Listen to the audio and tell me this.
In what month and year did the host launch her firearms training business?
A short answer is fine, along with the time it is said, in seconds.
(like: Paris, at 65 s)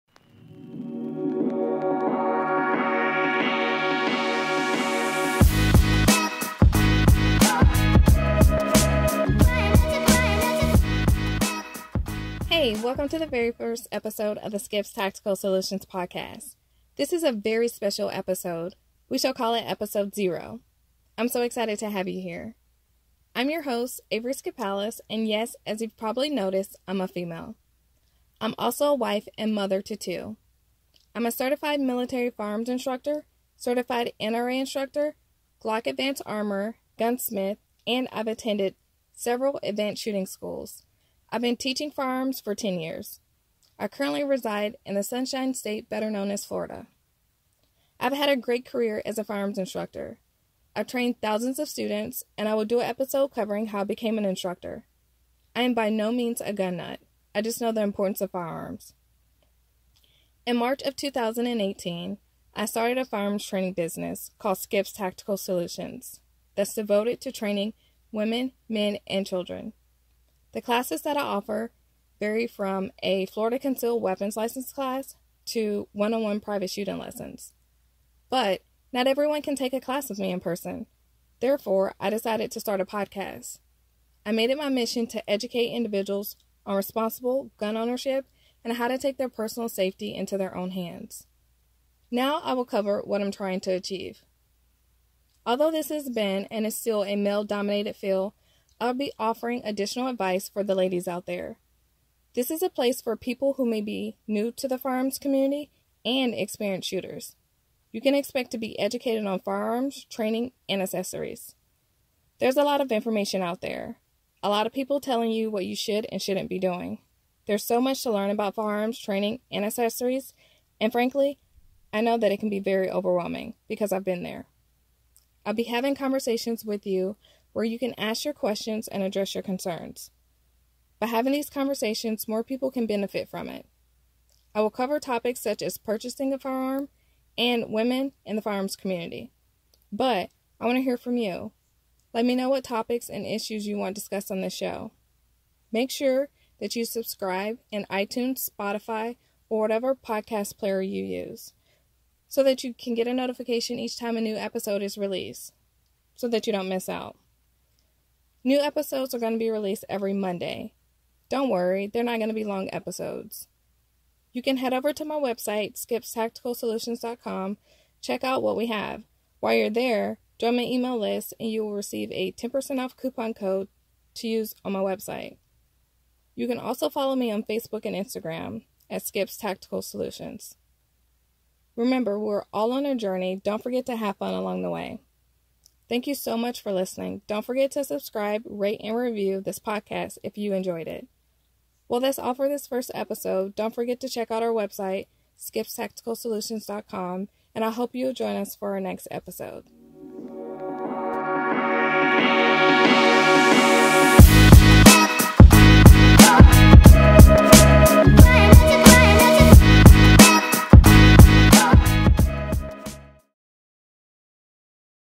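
March 2018, at 60 s.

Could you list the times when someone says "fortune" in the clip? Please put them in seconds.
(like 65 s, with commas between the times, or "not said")
not said.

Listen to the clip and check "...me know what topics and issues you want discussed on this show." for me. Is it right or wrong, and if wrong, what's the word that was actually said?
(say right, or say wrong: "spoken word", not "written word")
right.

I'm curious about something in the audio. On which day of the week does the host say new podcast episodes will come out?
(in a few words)
Monday.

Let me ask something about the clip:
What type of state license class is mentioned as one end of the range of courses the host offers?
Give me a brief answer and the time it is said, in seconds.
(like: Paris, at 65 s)
Florida Concealed Weapons License, at 73 s.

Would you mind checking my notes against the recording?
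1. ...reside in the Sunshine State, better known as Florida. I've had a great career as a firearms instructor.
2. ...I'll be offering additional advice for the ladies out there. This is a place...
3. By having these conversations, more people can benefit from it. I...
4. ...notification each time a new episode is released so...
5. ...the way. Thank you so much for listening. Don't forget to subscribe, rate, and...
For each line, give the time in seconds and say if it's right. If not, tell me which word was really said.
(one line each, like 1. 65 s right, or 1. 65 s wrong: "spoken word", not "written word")
1. 44 s right
2. 98 s right
3. 130 s right
4. 153 s right
5. 184 s right.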